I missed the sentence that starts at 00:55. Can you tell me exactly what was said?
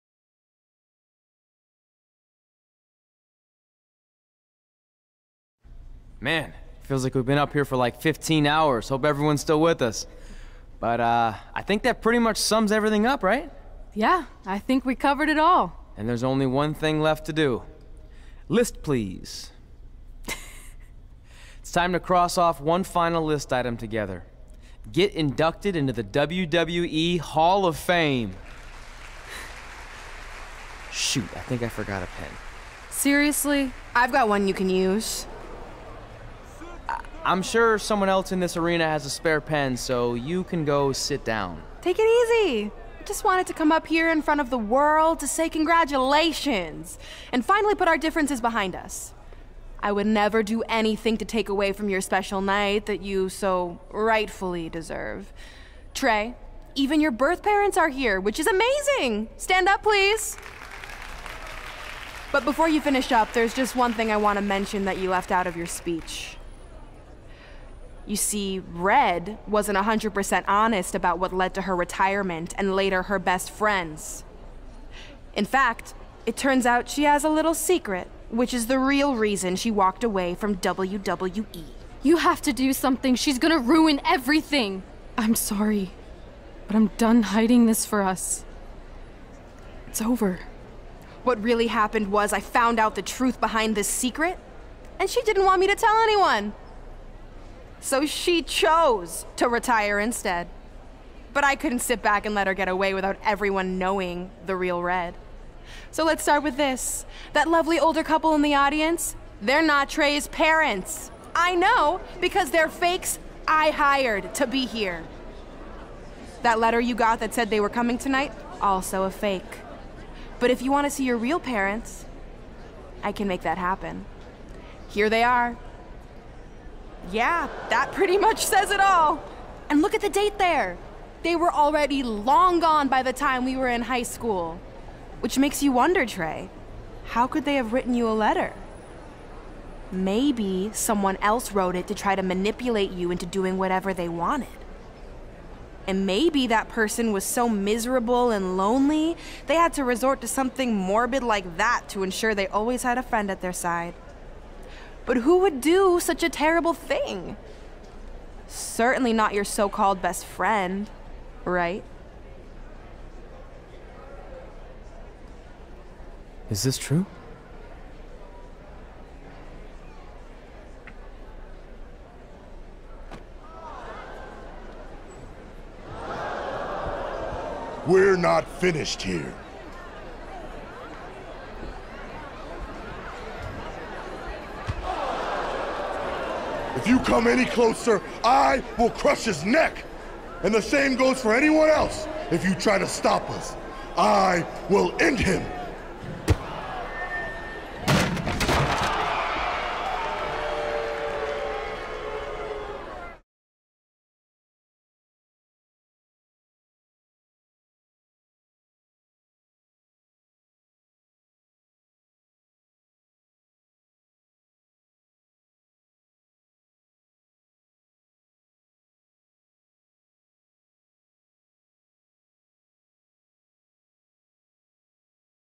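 Trey, even your birth parents are here, which is amazing.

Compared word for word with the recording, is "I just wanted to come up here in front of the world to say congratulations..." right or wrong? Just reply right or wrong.
right.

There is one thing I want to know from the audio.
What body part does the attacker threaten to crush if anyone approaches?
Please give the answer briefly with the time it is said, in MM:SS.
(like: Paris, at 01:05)
Neck, at 03:09.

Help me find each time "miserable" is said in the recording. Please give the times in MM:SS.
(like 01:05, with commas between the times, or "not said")
02:27.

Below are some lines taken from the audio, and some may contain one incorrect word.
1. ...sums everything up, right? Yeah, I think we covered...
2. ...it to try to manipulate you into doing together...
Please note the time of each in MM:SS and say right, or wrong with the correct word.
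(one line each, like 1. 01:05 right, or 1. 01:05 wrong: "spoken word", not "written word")
1. 00:12 right
2. 02:21 wrong: "whatever", not "together".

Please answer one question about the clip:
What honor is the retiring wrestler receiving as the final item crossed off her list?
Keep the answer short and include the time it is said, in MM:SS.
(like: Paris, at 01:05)
WWE Hall of Fame, at 00:26.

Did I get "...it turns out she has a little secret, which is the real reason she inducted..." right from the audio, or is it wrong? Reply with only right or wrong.
wrong.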